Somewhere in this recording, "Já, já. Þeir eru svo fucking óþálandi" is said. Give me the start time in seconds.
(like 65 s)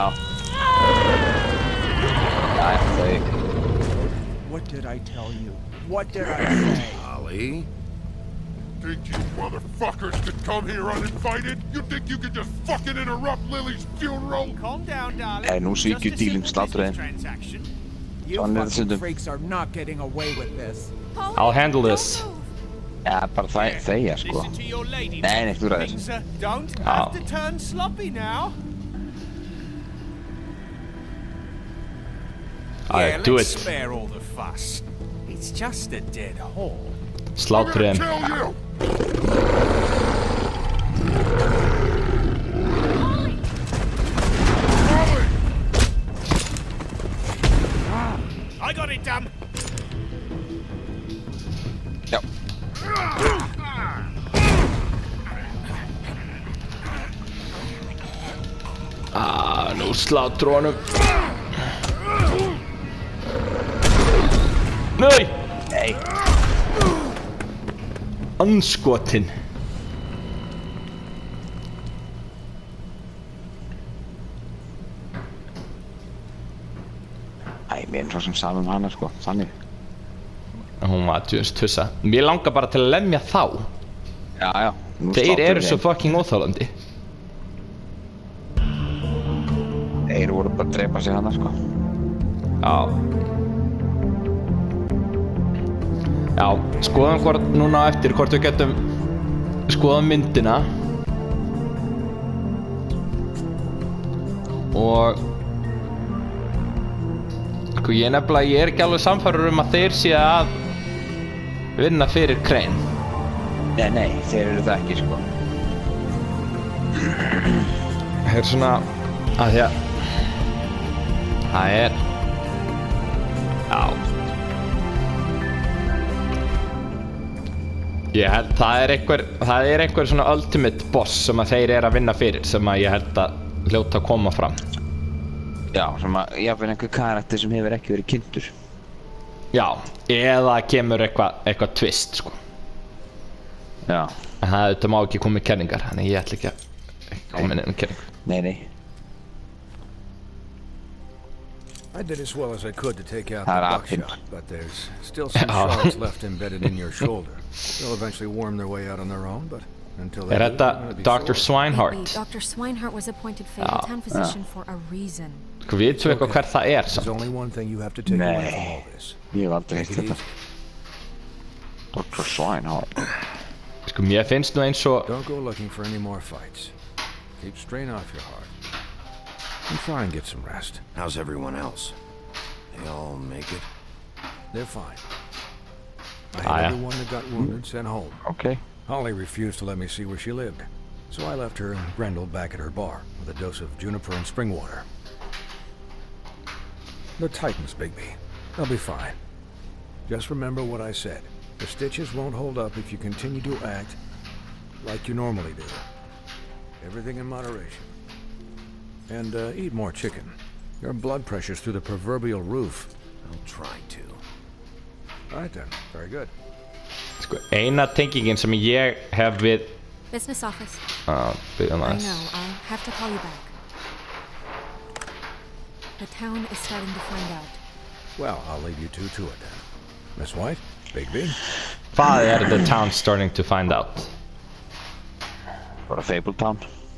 84 s.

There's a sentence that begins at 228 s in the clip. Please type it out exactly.
Well, I'll leave you two to it then.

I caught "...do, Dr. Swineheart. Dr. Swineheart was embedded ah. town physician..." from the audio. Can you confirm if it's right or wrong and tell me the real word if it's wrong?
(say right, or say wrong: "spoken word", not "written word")
wrong: "appointed", not "embedded".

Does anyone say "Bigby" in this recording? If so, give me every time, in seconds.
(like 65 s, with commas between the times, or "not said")
197 s, 230 s.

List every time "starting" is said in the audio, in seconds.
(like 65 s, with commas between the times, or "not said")
226 s, 232 s.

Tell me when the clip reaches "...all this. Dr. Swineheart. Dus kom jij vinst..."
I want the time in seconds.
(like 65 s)
169 s.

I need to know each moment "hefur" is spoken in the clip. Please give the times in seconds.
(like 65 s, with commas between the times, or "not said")
137 s.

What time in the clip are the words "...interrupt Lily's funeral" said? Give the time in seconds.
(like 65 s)
12 s.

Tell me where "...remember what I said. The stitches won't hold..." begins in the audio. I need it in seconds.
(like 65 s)
200 s.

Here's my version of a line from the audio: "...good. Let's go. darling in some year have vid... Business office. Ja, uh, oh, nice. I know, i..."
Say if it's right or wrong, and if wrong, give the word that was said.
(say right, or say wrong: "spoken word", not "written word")
wrong: "thinking", not "darling".